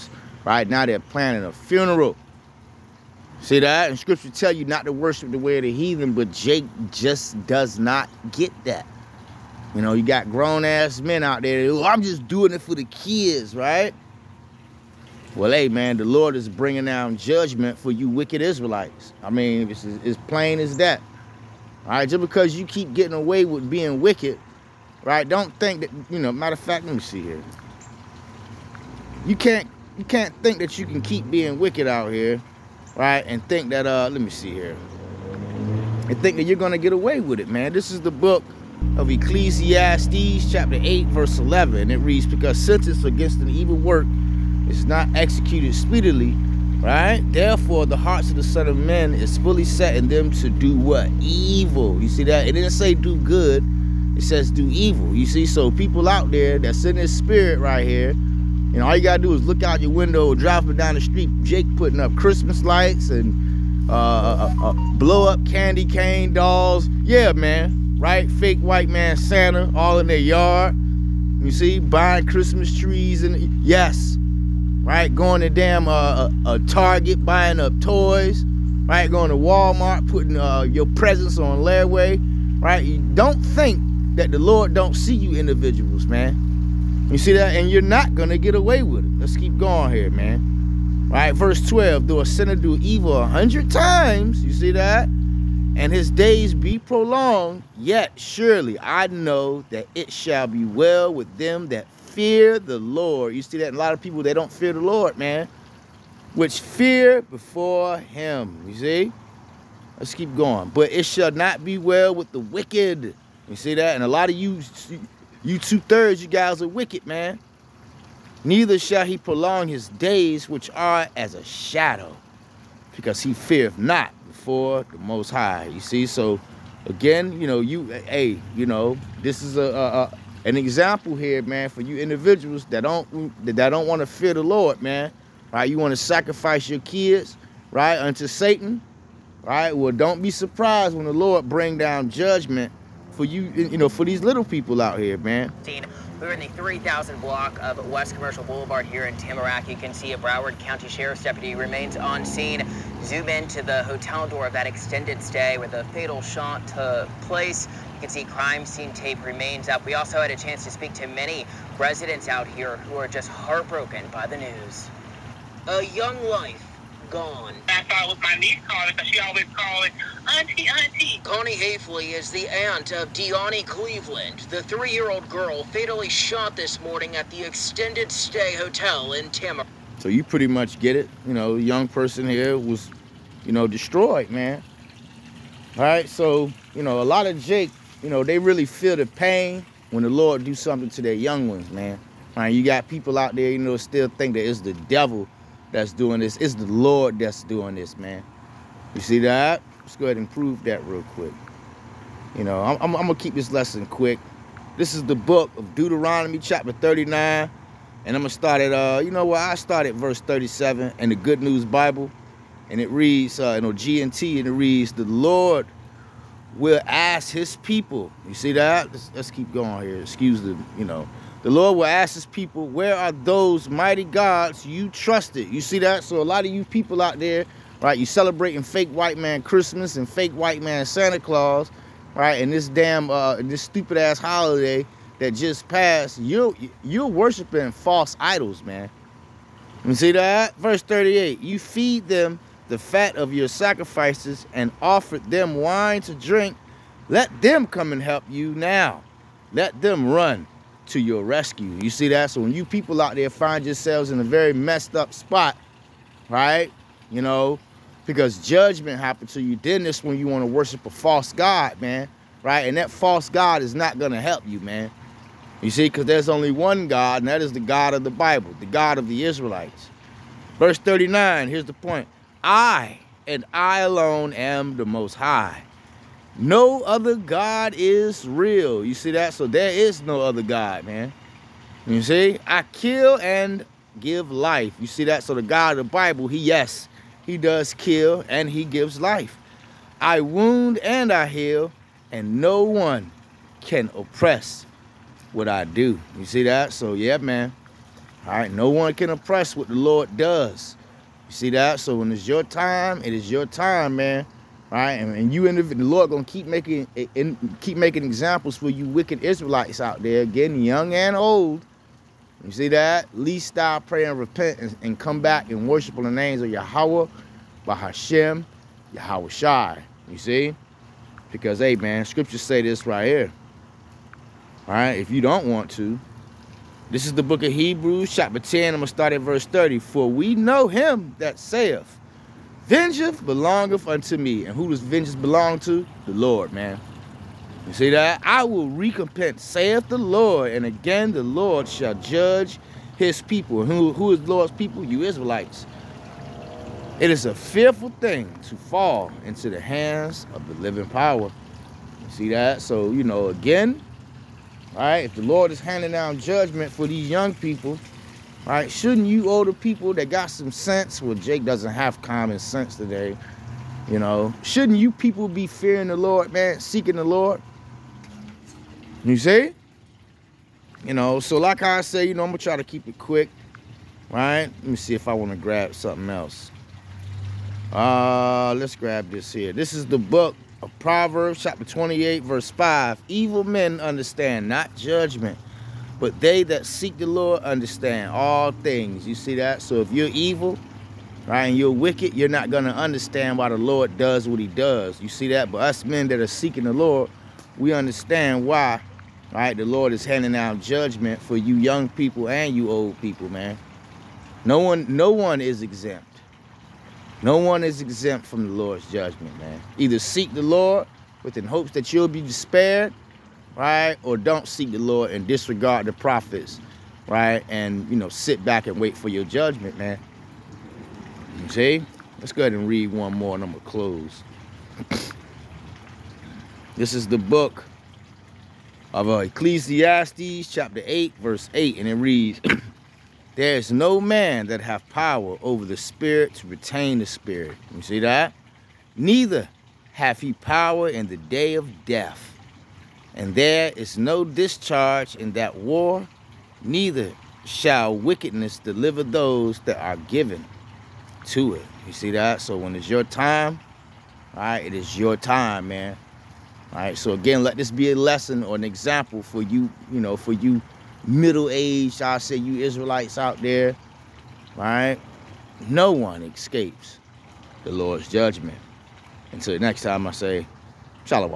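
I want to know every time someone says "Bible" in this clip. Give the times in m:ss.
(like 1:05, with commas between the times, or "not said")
3:31, 4:28, 4:45.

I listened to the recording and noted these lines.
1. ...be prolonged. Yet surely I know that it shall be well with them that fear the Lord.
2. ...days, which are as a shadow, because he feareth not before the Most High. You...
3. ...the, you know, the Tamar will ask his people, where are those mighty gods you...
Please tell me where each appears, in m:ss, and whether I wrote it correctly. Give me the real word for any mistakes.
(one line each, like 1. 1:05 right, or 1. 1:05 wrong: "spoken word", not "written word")
1. 1:36 right
2. 1:59 right
3. 3:40 wrong: "Lord", not "Tamar".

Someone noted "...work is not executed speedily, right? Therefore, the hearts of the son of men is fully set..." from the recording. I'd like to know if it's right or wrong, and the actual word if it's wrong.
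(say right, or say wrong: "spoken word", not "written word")
right.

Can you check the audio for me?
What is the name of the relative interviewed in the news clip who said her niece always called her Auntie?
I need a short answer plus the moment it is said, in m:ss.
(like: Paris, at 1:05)
Connie Hafley, at 2:51.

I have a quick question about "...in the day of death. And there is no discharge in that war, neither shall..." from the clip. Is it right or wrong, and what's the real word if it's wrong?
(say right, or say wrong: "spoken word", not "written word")
right.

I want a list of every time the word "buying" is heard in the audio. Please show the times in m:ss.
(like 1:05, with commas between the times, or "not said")
1:11, 1:17.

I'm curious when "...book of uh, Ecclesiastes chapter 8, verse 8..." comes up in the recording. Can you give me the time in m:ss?
7:07.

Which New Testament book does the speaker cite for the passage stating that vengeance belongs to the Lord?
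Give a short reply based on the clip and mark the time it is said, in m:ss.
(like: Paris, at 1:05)
Hebrews, at 5:27.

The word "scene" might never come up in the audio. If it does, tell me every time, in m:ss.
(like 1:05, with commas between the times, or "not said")
2:32, 2:38.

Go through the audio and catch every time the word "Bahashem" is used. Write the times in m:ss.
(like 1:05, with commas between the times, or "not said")
5:17.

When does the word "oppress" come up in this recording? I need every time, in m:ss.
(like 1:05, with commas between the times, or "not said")
4:53, 4:59.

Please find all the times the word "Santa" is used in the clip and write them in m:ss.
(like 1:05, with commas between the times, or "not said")
1:09, 3:50.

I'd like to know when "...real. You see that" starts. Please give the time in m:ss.
4:38.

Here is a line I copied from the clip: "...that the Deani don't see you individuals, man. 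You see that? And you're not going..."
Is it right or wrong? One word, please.
wrong.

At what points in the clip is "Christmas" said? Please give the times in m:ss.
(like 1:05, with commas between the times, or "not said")
1:02, 1:12, 3:49.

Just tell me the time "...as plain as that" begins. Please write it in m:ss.
0:19.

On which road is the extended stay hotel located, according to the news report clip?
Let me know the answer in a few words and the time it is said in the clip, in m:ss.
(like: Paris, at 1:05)
West Commercial Boulevard, at 2:27.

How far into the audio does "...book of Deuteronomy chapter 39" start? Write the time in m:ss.
3:25.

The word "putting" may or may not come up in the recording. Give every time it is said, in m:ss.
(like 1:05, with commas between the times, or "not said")
1:01, 1:20.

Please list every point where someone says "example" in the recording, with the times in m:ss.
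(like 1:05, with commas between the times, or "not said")
2:10, 5:08, 7:38.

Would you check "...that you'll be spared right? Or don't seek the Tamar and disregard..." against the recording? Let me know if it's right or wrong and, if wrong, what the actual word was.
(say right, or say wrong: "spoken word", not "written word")
wrong: "Lord", not "Tamar".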